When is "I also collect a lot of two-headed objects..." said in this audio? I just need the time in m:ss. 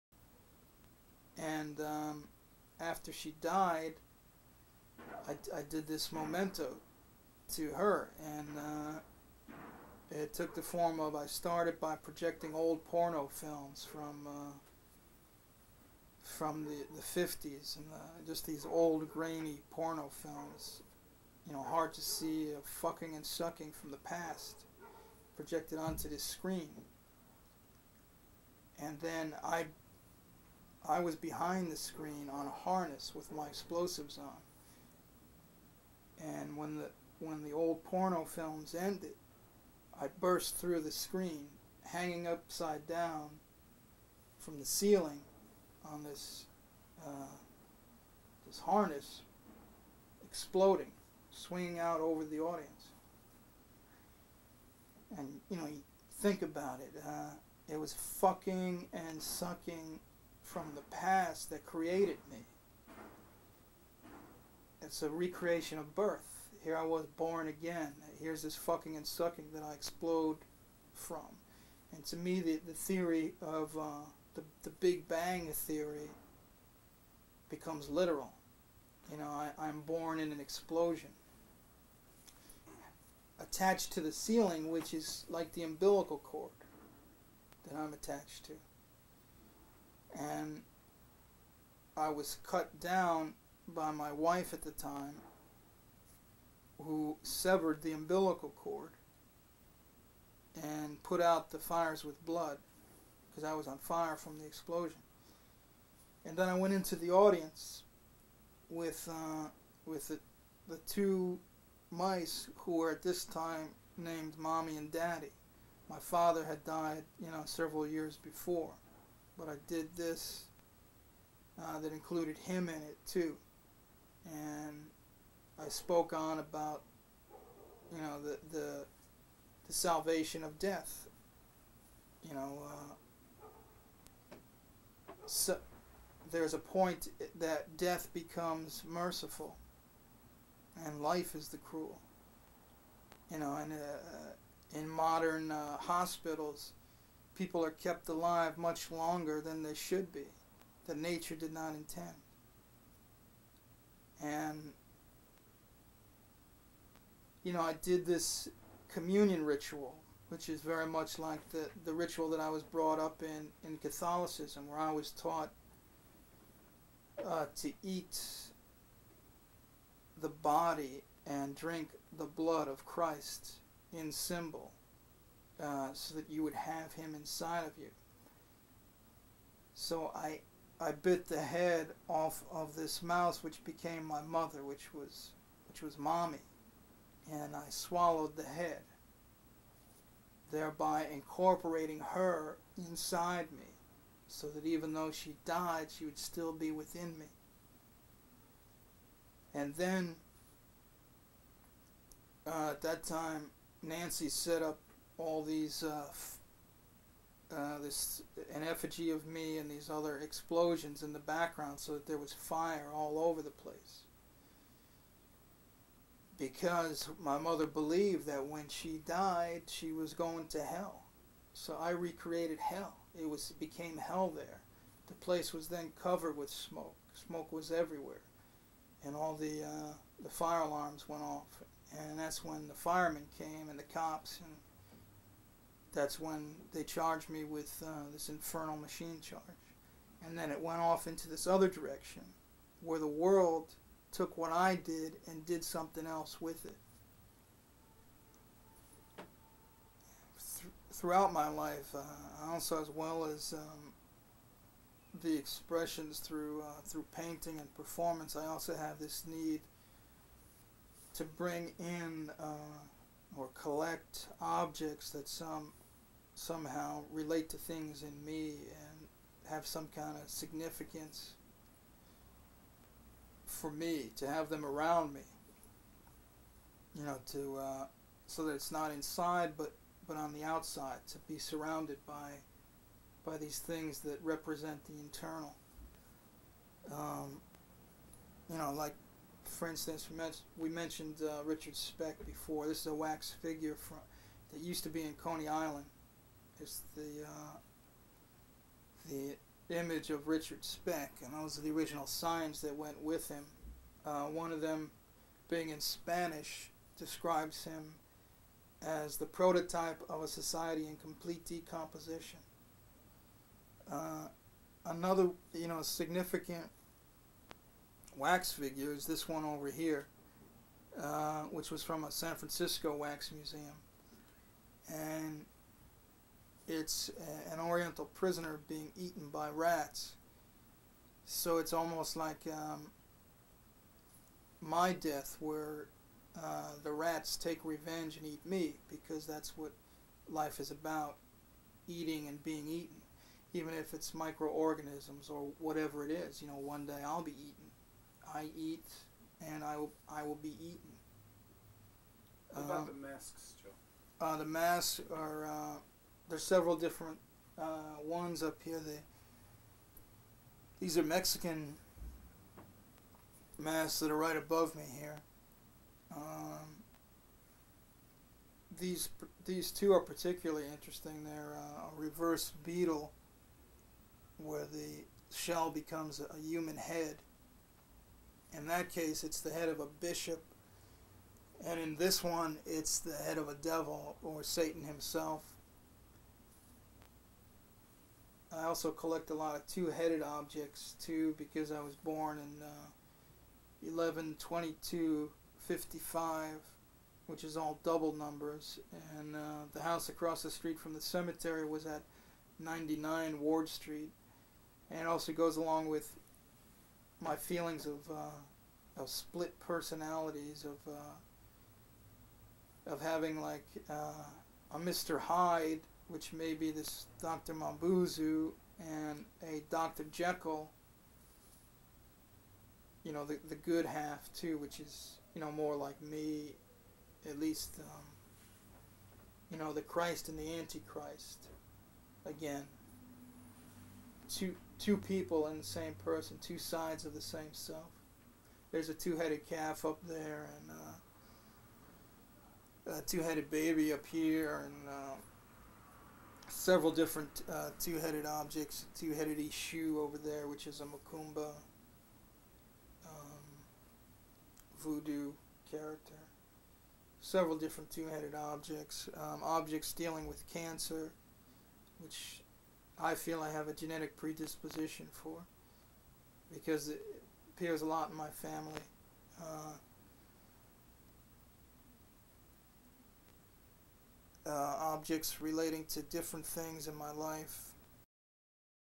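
6:28.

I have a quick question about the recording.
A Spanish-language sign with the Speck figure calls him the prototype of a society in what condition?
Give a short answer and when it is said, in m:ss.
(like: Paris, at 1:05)
complete decomposition, at 5:10.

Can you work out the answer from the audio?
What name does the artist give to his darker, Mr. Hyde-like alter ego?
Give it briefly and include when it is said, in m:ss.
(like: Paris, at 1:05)
Dr. Mambuzu, at 6:57.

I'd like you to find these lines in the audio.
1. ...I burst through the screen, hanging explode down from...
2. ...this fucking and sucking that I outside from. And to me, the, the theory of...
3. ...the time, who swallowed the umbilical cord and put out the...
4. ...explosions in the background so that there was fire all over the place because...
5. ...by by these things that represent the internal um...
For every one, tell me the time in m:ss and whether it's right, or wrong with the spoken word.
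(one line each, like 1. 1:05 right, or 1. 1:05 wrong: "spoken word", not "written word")
1. 0:40 wrong: "upside", not "explode"
2. 1:08 wrong: "explode", not "outside"
3. 1:34 wrong: "severed", not "swallowed"
4. 3:30 right
5. 4:42 right.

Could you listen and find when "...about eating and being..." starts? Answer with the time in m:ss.
5:40.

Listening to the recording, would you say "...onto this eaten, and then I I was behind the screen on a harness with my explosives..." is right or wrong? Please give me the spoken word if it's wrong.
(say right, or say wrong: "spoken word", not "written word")
wrong: "screen", not "eaten".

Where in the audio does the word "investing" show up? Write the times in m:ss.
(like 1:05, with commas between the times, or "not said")
not said.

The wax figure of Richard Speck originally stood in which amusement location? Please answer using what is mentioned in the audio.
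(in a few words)
Coney Island.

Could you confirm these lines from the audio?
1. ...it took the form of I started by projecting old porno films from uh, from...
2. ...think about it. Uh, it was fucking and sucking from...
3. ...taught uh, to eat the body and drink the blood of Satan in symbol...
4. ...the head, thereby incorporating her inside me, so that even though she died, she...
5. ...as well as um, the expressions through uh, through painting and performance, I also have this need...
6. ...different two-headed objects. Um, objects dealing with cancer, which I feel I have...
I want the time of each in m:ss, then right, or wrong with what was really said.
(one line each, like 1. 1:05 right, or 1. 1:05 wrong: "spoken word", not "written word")
1. 0:10 right
2. 0:56 right
3. 2:45 wrong: "Christ", not "Satan"
4. 3:08 right
5. 4:12 right
6. 7:37 right.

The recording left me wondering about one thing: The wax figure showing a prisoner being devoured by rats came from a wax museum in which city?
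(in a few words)
San Francisco.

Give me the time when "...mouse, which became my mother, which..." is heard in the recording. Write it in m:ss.
3:03.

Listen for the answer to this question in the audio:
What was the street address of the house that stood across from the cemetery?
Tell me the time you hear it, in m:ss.
6:42.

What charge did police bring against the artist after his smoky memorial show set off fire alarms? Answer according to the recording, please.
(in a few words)
infernal machine.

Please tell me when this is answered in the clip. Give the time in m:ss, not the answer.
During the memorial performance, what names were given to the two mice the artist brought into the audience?
1:54.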